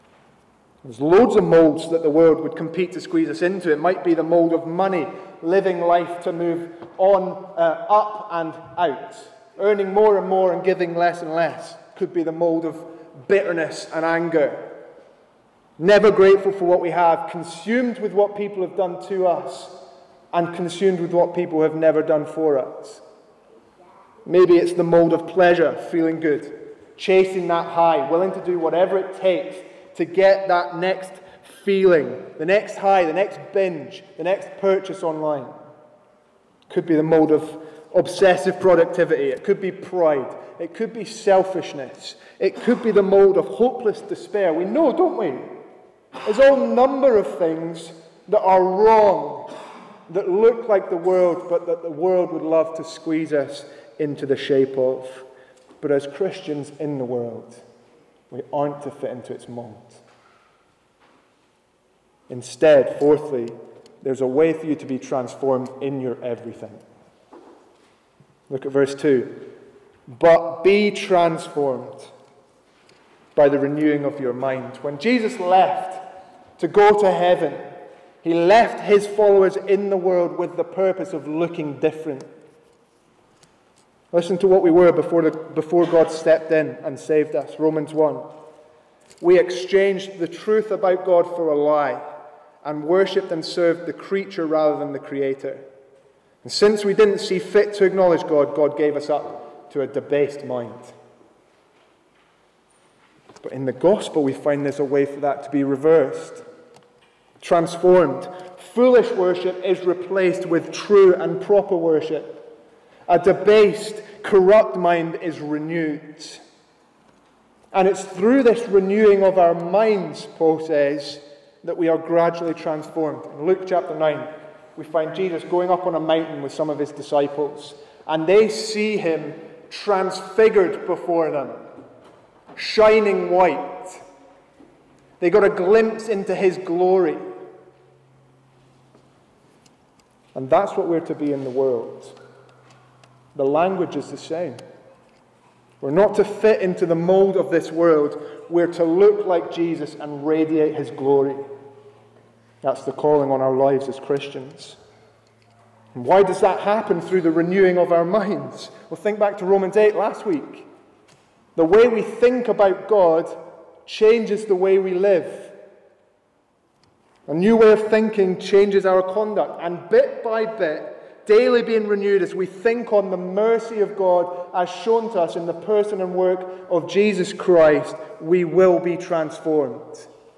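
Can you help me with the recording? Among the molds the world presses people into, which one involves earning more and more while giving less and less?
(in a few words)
Money.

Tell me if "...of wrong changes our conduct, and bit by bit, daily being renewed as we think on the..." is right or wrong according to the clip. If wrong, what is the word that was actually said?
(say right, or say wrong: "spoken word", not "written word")
wrong: "thinking", not "wrong".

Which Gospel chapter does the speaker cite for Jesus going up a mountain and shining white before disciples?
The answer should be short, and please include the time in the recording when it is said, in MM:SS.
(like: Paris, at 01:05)
Luke 9, at 02:03.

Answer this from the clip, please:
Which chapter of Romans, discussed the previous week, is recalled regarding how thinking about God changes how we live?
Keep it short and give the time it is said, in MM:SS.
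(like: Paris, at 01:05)
Romans 8, at 02:39.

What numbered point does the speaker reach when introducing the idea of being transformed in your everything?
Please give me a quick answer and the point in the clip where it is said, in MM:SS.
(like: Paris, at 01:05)
Fourthly, at 01:02.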